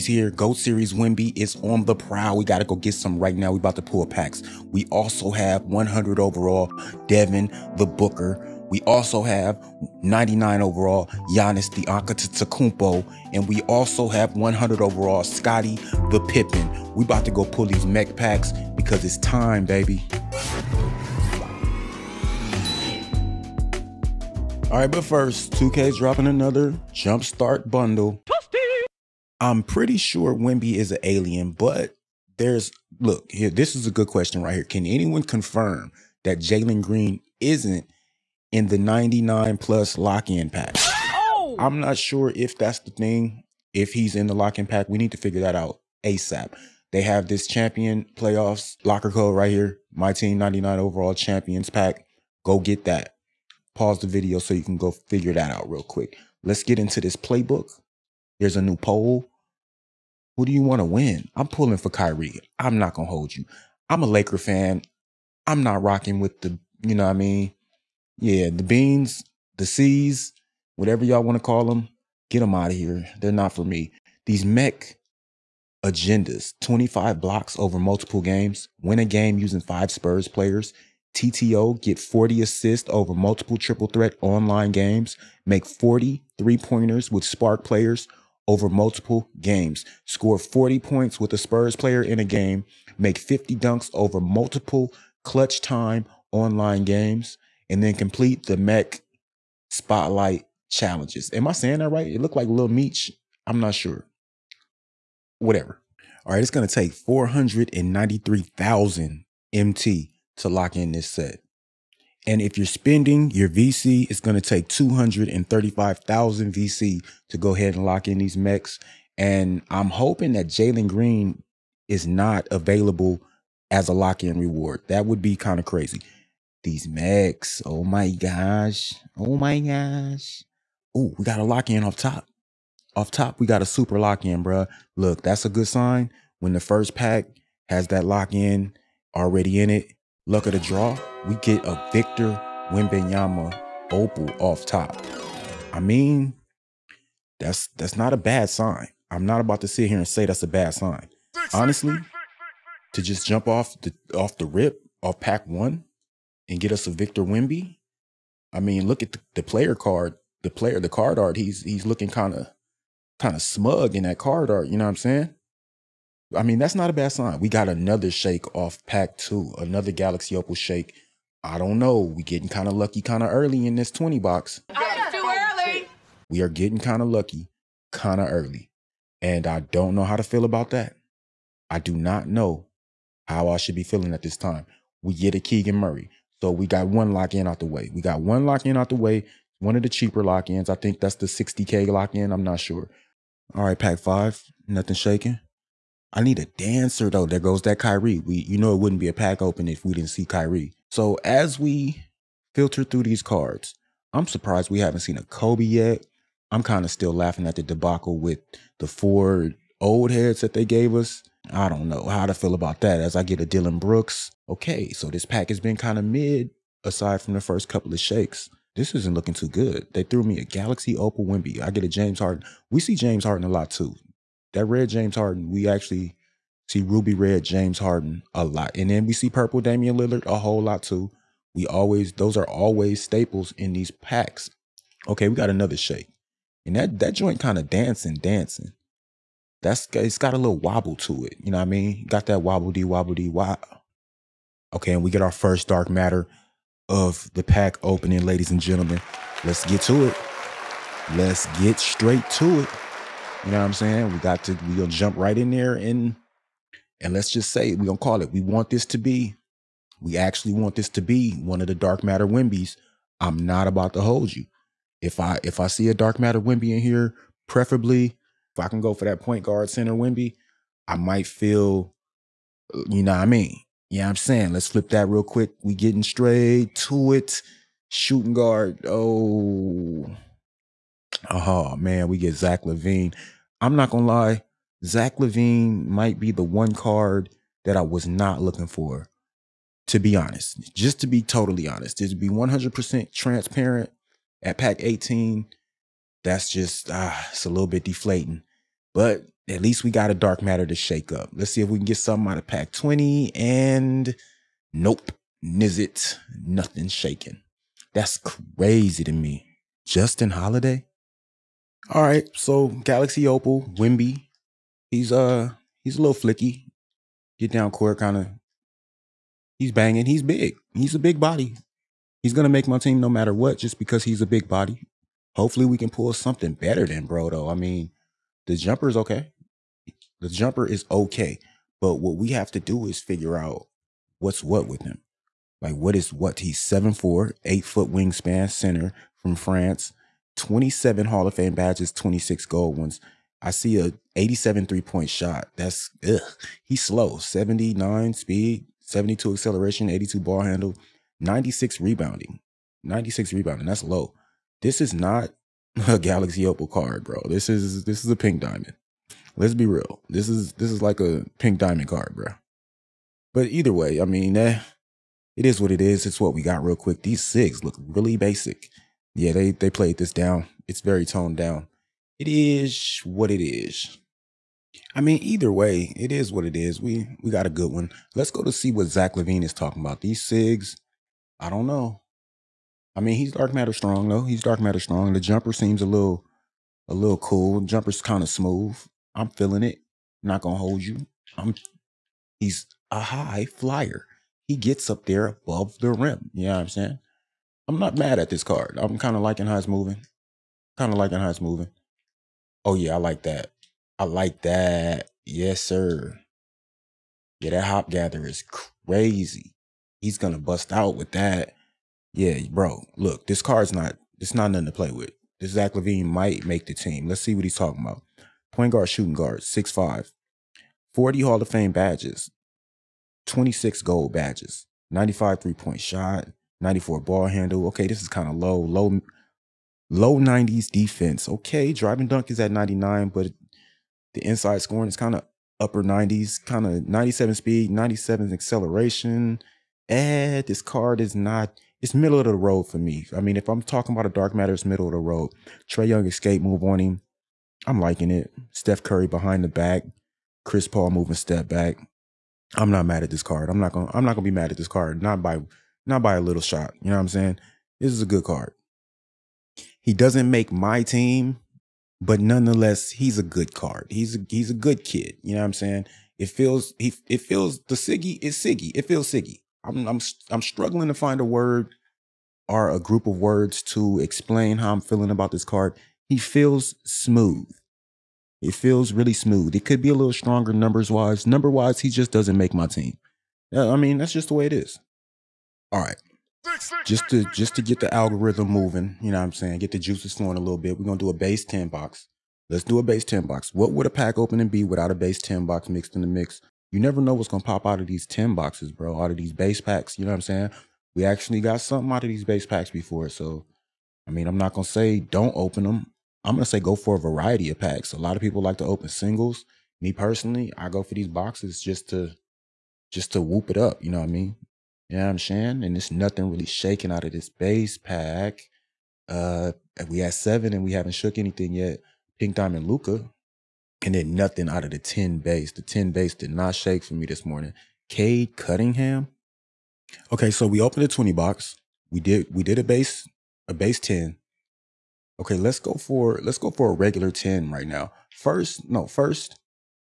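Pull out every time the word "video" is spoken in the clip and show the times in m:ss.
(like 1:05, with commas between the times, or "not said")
0:54.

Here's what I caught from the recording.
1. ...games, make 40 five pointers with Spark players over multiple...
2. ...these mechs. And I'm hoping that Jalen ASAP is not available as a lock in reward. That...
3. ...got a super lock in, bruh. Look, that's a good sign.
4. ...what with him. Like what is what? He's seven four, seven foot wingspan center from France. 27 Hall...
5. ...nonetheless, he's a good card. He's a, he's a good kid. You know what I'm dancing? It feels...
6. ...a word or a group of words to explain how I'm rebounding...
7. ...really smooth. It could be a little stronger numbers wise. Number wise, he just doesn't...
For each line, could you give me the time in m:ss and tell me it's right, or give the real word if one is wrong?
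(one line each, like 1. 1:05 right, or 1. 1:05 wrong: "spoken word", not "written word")
1. 1:24 wrong: "three", not "five"
2. 1:58 wrong: "Green", not "ASAP"
3. 2:13 right
4. 5:34 wrong: "eight", not "seven"
5. 7:42 wrong: "saying", not "dancing"
6. 7:51 wrong: "feeling", not "rebounding"
7. 7:58 right.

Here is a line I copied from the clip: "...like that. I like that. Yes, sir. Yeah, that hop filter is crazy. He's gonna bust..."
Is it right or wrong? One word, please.
wrong.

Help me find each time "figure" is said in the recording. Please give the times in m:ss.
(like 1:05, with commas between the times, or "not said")
0:45, 0:54, 5:33.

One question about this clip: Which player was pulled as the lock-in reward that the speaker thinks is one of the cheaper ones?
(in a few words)
Keegan Murray.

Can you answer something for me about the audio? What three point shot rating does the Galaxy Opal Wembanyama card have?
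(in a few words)
87.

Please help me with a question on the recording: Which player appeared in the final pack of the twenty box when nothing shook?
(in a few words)
Justin Holiday.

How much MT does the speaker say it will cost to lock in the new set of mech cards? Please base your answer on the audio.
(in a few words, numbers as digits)
493,000 MT.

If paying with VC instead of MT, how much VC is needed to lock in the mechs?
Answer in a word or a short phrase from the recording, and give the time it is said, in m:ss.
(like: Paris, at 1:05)
235,000 VC, at 1:54.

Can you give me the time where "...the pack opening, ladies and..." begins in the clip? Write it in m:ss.
4:07.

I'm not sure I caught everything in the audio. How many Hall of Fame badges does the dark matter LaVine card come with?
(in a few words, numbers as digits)
40.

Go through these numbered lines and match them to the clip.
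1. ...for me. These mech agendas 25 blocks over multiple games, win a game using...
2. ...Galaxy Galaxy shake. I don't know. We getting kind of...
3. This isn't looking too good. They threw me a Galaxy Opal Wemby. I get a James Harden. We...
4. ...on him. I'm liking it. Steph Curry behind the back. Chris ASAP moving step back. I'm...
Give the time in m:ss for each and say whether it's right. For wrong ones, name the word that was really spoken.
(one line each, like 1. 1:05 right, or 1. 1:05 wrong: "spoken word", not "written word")
1. 1:13 right
2. 2:49 wrong: "Opal", not "Galaxy"
3. 3:38 right
4. 7:26 wrong: "Paul", not "ASAP".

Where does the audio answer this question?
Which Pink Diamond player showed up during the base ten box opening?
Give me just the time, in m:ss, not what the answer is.
8:42.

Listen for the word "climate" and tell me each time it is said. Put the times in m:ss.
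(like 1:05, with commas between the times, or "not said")
not said.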